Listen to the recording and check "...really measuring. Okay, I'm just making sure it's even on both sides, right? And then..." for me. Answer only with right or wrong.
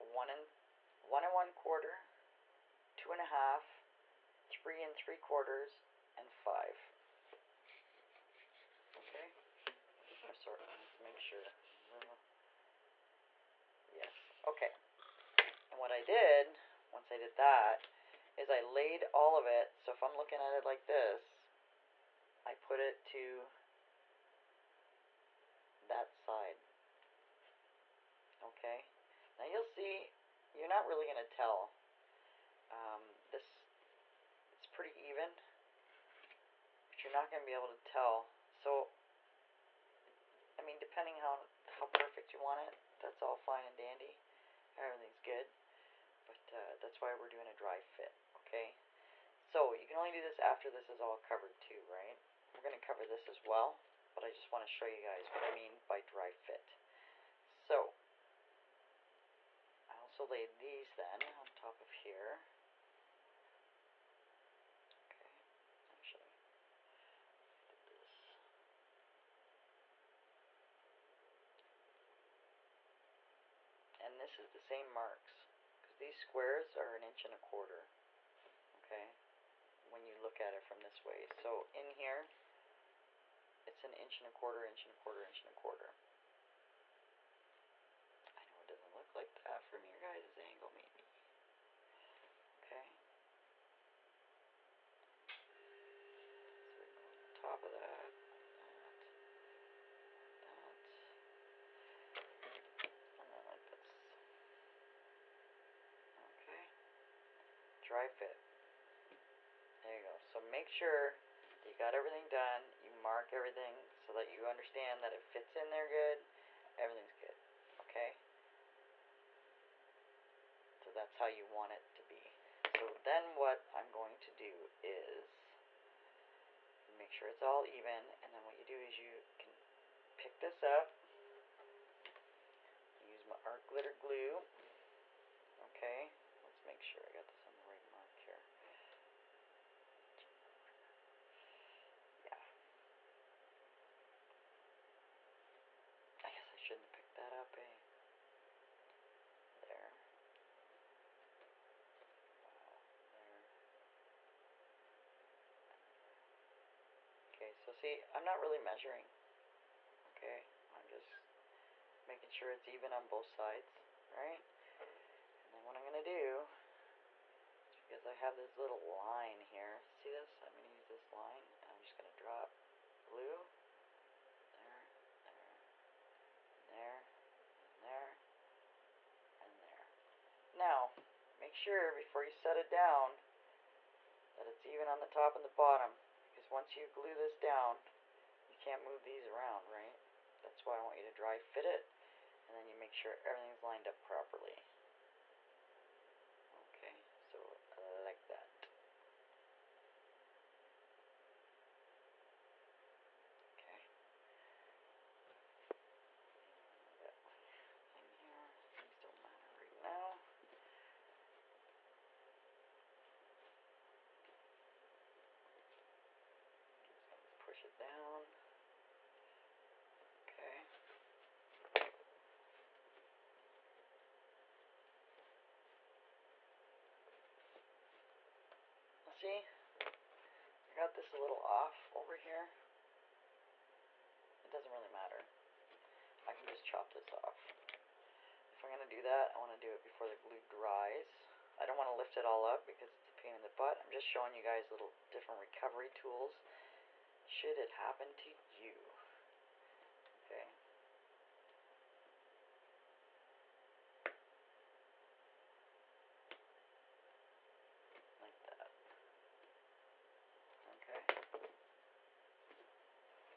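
right.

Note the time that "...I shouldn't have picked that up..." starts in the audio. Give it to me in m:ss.
2:26.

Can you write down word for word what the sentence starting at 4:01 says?
I don't want to lift it all up because it's a pain in the butt.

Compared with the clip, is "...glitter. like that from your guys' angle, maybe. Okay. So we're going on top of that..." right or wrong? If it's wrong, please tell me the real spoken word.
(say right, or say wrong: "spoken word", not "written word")
wrong: "quarter", not "glitter".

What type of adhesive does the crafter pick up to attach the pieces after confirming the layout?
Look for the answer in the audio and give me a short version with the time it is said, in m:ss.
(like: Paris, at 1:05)
art glitter glue, at 2:13.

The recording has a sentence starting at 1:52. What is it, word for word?
You mark everything so that you understand that it fits in there good.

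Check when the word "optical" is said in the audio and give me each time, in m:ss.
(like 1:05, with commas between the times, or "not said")
not said.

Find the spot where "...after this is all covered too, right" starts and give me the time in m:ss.
0:50.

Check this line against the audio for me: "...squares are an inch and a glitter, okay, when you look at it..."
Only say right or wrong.
wrong.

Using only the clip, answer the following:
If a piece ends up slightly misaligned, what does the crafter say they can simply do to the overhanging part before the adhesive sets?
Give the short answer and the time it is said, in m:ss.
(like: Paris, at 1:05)
chop this off, at 3:56.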